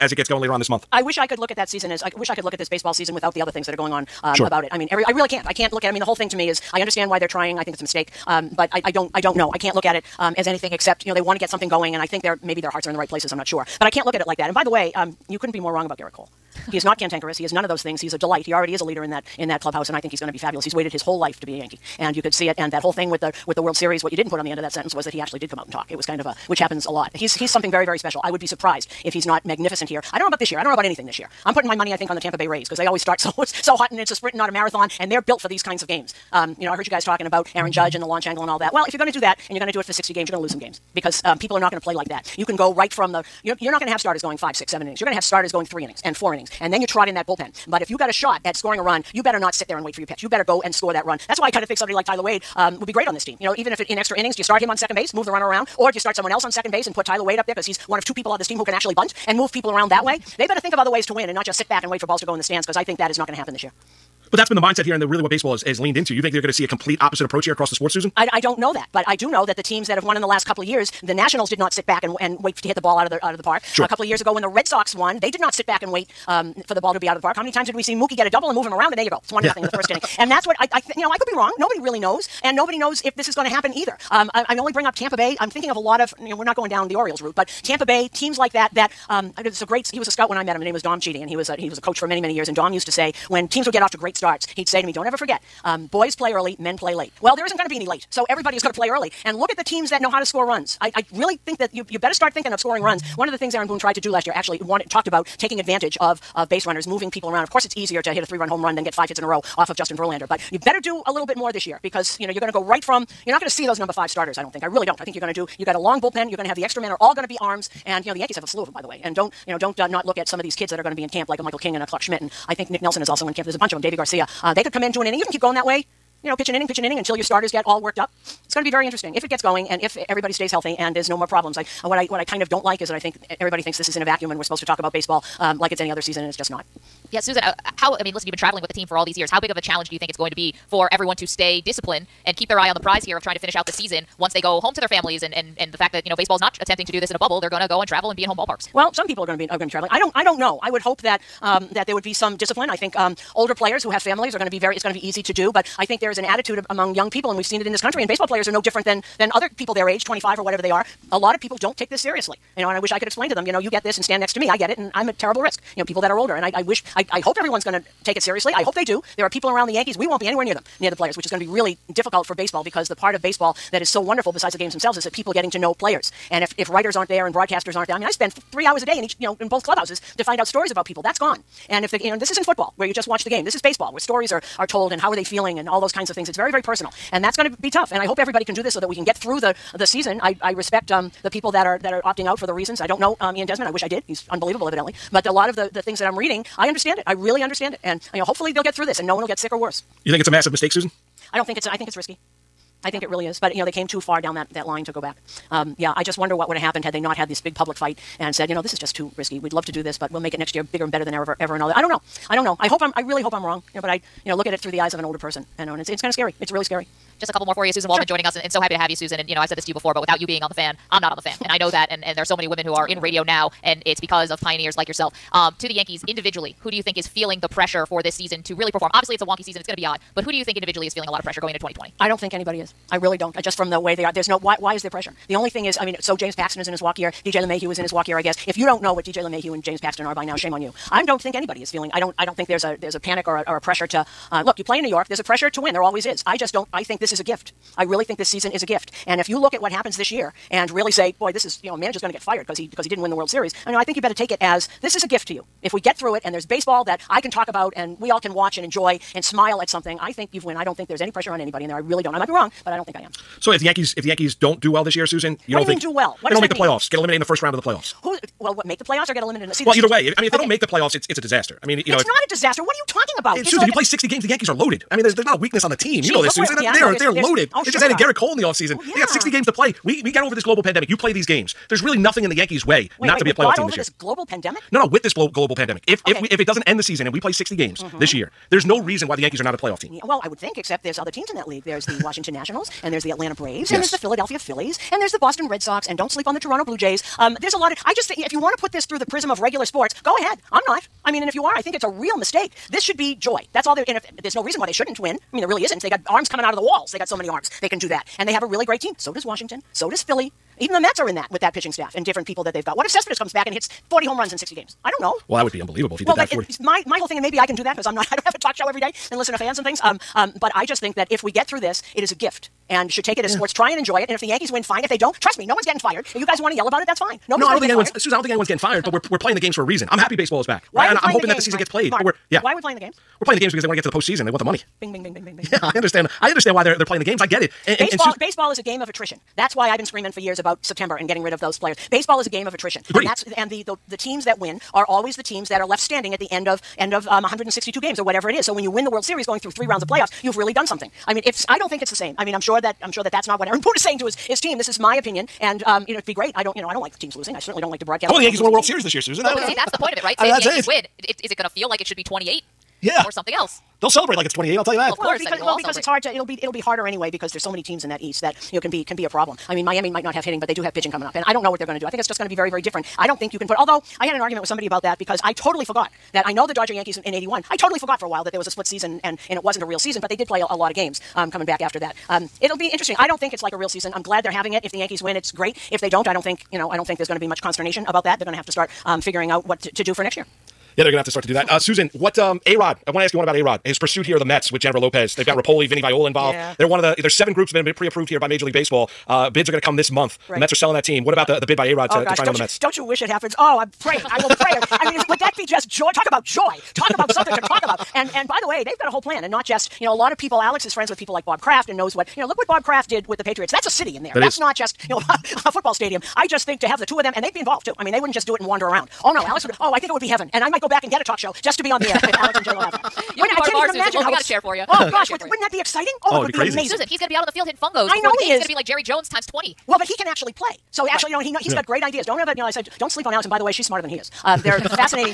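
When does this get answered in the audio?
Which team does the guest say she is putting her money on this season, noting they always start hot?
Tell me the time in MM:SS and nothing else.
00:32.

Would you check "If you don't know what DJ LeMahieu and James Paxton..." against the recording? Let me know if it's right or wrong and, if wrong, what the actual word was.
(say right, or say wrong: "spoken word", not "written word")
right.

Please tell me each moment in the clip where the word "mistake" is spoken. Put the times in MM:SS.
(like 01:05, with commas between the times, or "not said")
00:07, 03:20, 05:02.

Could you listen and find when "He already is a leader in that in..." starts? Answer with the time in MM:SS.
00:18.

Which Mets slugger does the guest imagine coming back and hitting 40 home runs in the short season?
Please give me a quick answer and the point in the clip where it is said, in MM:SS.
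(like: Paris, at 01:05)
Cespedes, at 05:12.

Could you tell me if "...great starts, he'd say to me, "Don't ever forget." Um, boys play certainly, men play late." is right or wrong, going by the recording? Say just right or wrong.
wrong.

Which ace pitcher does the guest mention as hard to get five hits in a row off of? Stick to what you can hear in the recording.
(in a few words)
Justin Verlander.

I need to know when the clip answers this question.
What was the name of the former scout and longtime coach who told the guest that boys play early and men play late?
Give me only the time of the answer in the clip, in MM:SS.
01:30.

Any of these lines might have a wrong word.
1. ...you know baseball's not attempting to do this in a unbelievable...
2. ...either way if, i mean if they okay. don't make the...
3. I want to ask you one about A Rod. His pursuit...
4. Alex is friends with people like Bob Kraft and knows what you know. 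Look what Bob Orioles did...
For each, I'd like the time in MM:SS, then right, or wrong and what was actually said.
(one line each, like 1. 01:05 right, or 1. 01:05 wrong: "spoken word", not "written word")
1. 02:26 wrong: "bubble", not "unbelievable"
2. 04:29 right
3. 06:32 right
4. 06:50 wrong: "Kraft", not "Orioles".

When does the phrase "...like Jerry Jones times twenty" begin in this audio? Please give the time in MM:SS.
07:08.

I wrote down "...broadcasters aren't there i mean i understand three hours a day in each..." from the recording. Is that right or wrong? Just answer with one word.
wrong.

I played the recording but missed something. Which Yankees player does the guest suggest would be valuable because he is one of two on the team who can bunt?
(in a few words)
Tyler Wade.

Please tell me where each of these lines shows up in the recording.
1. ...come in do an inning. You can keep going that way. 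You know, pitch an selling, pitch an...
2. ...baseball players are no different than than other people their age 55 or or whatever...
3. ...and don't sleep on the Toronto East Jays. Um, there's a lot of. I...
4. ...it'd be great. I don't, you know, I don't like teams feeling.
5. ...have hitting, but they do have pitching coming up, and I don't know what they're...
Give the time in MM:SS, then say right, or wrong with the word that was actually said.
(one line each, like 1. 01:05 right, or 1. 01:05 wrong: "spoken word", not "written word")
1. 02:04 wrong: "inning", not "selling"
2. 02:38 wrong: "25", not "55"
3. 04:55 wrong: "Blue", not "East"
4. 05:55 wrong: "losing", not "feeling"
5. 06:10 right.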